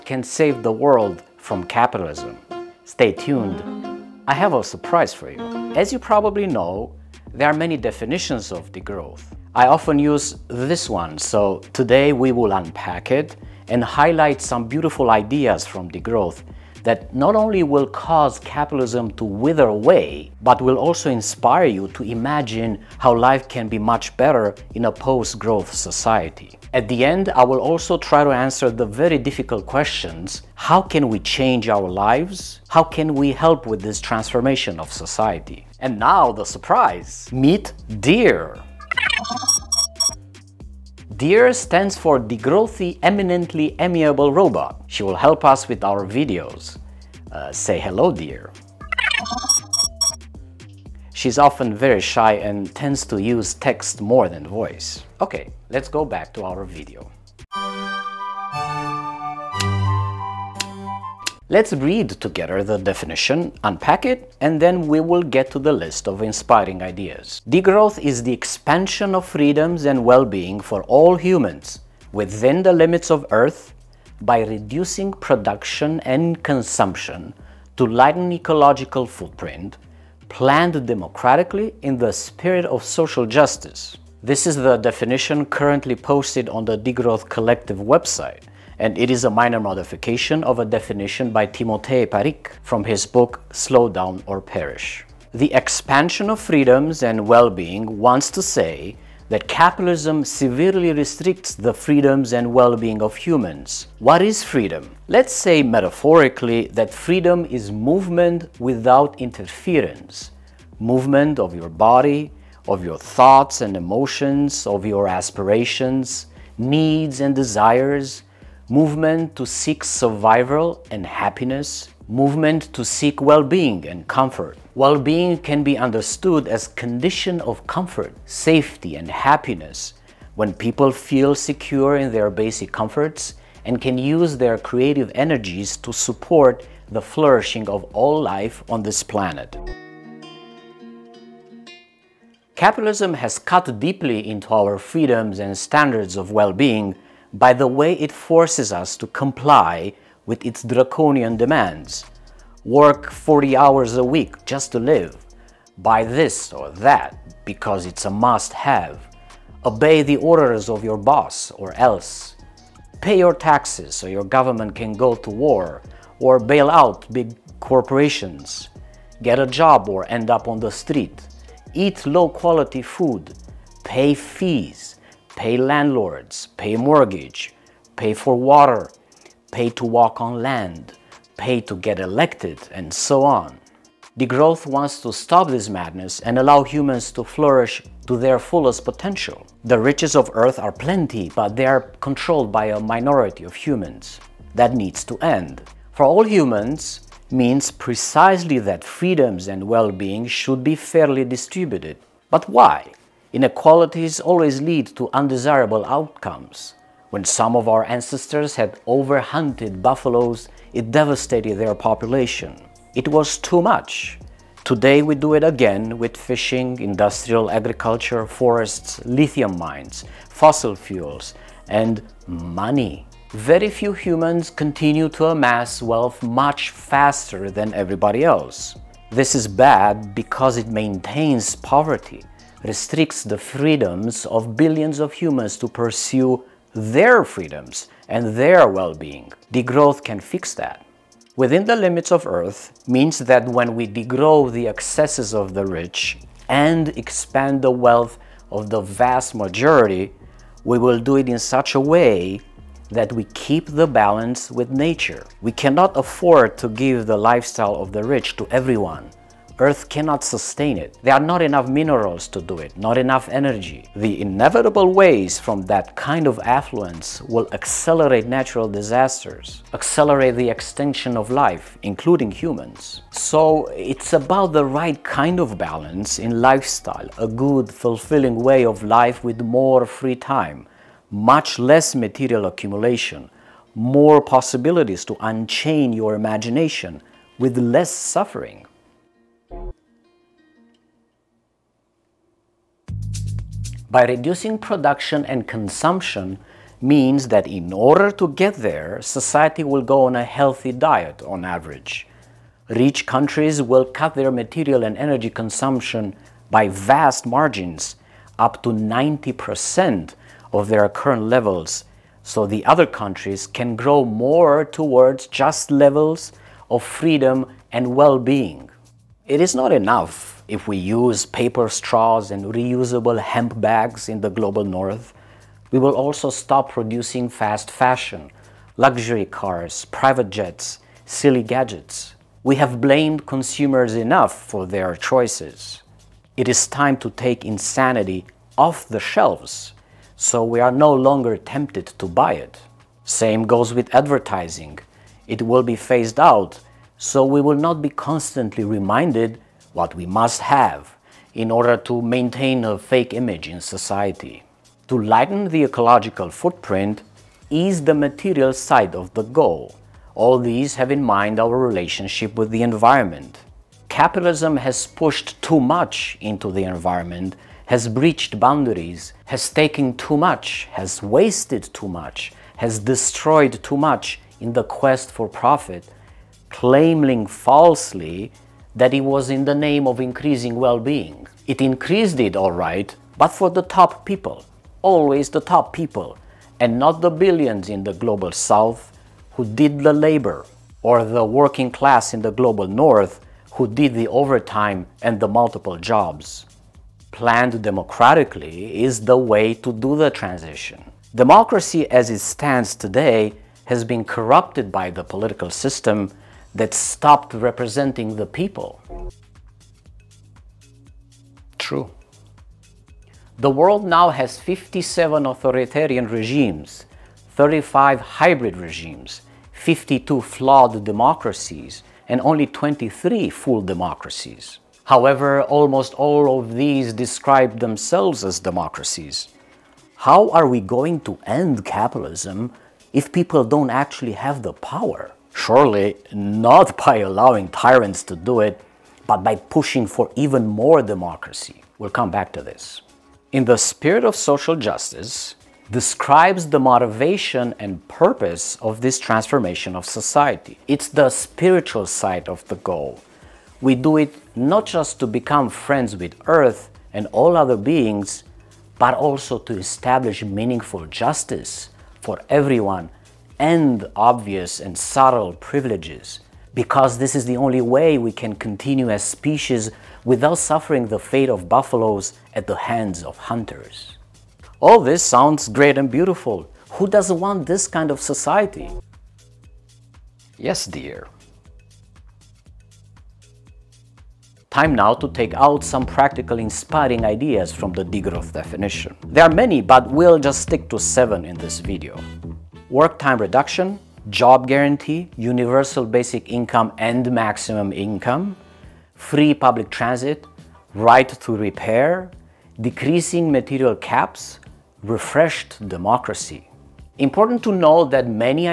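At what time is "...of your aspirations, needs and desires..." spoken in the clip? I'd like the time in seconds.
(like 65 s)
114 s.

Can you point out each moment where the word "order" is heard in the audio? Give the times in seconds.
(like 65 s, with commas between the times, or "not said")
160 s, 297 s, 351 s.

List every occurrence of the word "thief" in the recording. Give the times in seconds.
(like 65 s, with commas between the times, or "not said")
not said.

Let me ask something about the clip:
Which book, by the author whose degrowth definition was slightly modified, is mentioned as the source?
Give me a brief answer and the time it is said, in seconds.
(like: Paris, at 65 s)
Slow Down or Perish, at 93 s.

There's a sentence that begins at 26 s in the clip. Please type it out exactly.
At the end, I will also try to answer the very difficult questions.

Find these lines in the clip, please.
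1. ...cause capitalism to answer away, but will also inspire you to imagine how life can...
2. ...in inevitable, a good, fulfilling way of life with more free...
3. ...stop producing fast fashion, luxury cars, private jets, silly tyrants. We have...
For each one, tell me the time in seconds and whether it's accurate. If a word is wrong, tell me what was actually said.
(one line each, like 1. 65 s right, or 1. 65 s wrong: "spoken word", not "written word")
1. 17 s wrong: "wither", not "answer"
2. 276 s wrong: "lifestyle", not "inevitable"
3. 326 s wrong: "gadgets", not "tyrants".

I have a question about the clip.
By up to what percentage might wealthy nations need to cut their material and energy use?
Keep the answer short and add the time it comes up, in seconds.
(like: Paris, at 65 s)
90%, at 308 s.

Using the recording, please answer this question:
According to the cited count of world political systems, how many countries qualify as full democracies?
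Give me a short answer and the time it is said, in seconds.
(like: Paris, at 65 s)
23, at 422 s.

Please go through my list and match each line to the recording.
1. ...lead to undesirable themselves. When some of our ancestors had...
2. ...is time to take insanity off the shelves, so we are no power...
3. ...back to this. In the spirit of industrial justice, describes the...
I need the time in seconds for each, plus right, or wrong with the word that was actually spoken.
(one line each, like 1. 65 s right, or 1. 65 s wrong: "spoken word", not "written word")
1. 204 s wrong: "outcomes", not "themselves"
2. 336 s wrong: "longer", not "power"
3. 442 s wrong: "social", not "industrial".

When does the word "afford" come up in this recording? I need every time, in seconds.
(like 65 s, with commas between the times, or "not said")
255 s.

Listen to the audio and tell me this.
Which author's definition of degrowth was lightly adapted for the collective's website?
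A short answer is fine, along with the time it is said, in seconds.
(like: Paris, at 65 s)
Timothée Parrique, at 91 s.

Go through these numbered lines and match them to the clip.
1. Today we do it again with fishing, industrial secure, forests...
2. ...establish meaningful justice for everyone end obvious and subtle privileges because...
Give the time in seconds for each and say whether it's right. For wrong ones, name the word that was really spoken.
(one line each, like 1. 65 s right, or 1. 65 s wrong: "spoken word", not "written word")
1. 214 s wrong: "agriculture", not "secure"
2. 459 s right.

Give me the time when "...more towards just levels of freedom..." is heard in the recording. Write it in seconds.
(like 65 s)
314 s.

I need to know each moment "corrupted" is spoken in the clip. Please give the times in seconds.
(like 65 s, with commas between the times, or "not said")
404 s.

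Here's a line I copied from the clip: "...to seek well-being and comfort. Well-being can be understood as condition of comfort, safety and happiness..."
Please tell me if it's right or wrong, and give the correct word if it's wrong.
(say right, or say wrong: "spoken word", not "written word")
right.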